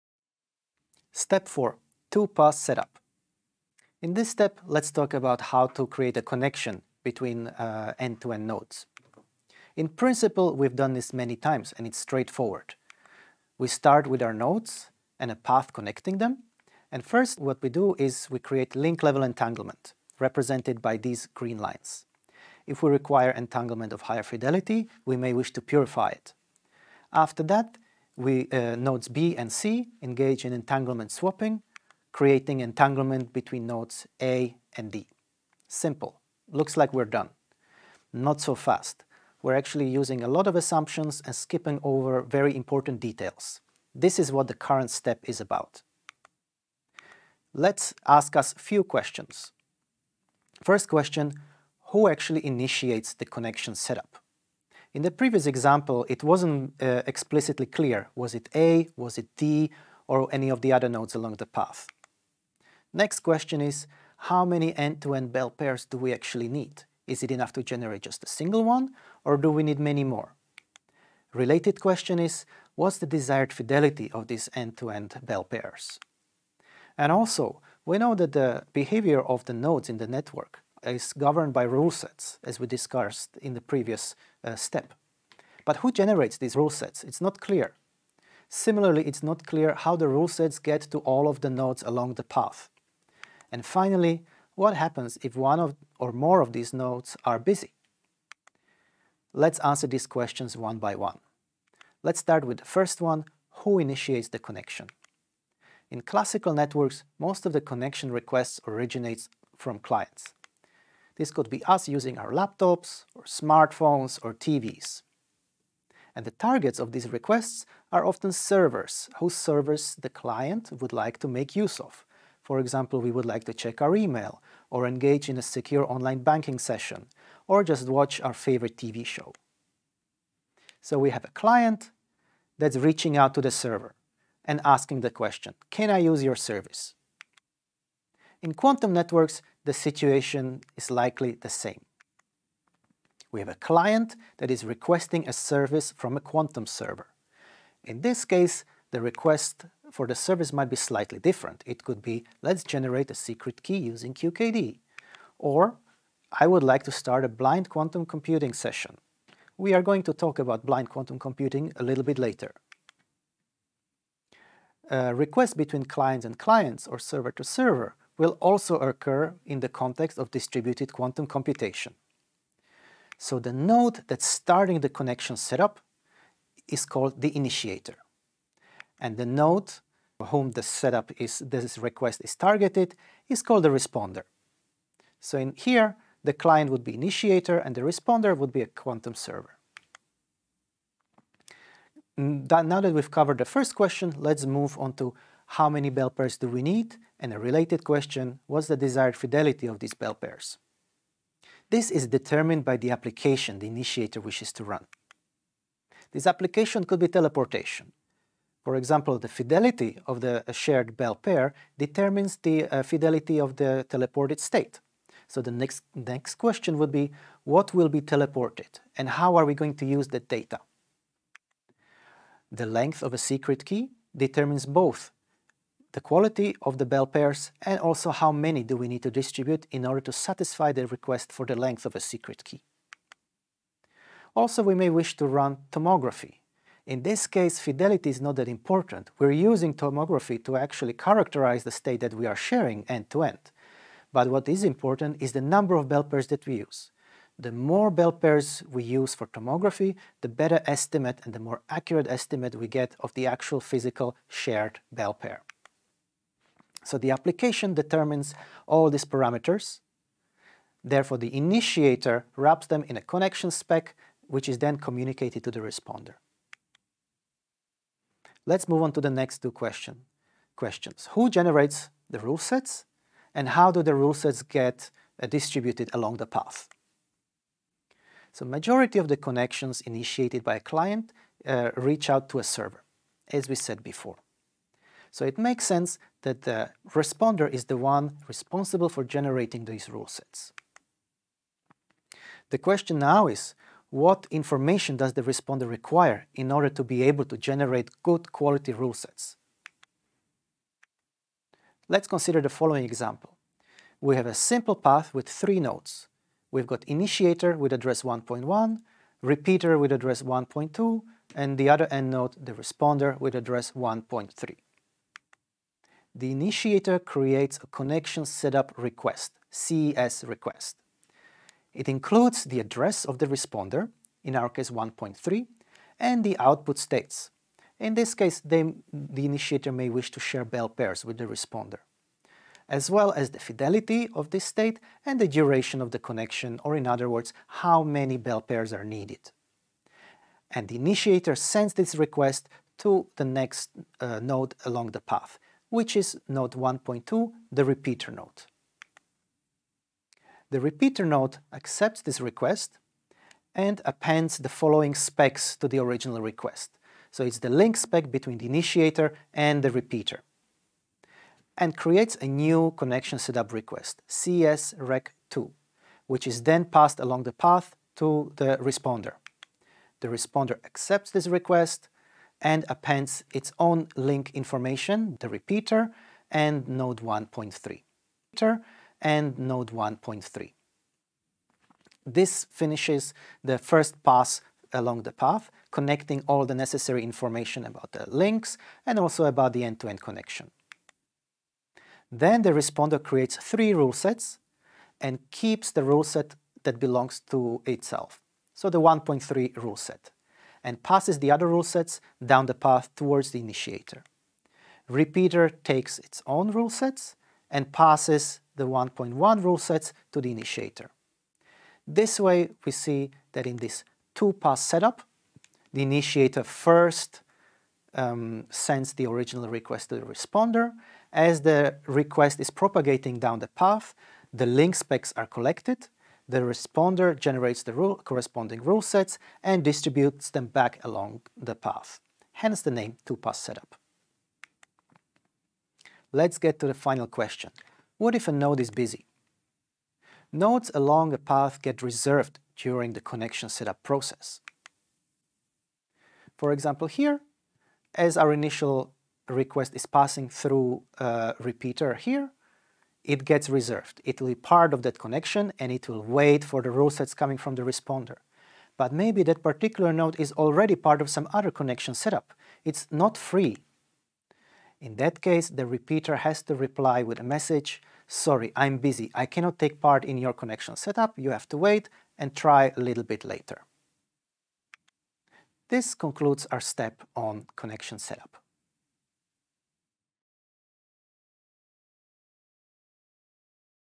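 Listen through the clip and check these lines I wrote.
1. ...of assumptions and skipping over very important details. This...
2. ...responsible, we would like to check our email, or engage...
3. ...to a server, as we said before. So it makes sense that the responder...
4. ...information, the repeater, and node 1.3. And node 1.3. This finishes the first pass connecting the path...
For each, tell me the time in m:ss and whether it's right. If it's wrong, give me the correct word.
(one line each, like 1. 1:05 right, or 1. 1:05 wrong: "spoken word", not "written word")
1. 0:40 right
2. 2:02 wrong: "example", not "responsible"
3. 4:42 right
4. 6:14 wrong: "along", not "connecting".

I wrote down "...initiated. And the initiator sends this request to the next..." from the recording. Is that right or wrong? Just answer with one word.
wrong.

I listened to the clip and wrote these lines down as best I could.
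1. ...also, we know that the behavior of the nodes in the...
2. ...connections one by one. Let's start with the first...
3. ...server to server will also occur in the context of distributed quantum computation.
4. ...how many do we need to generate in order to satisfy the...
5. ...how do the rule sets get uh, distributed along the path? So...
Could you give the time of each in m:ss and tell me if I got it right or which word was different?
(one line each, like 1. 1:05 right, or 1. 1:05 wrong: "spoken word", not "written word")
1. 1:17 right
2. 1:40 wrong: "questions", not "connections"
3. 2:46 right
4. 3:48 wrong: "distribute", not "generate"
5. 4:33 right.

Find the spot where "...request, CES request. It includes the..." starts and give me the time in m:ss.
5:18.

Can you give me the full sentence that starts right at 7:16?
Let's get to the final question.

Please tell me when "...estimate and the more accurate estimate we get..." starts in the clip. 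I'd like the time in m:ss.
4:10.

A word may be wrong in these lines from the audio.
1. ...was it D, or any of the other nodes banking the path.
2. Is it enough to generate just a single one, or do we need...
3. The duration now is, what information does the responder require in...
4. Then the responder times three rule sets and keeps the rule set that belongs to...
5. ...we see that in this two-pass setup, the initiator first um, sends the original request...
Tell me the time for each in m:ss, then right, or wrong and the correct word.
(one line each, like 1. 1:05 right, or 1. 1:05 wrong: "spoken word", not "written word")
1. 0:58 wrong: "along", not "banking"
2. 1:07 right
3. 4:52 wrong: "question", not "duration"
4. 6:32 wrong: "creates", not "times"
5. 6:52 right.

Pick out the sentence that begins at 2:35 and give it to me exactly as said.
Or, I would like to start a blind quantum computing session.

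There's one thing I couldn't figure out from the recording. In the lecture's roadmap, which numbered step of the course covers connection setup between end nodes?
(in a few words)
Step 4.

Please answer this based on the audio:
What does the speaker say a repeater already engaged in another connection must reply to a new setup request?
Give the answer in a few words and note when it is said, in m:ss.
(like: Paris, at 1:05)
sorry, I'm busy, at 7:48.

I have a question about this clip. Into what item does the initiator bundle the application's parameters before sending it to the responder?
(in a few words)
connection spec.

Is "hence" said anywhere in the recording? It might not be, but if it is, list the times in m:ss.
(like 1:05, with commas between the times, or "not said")
7:12.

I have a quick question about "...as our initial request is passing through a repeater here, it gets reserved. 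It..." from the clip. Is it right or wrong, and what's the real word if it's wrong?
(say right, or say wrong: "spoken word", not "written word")
right.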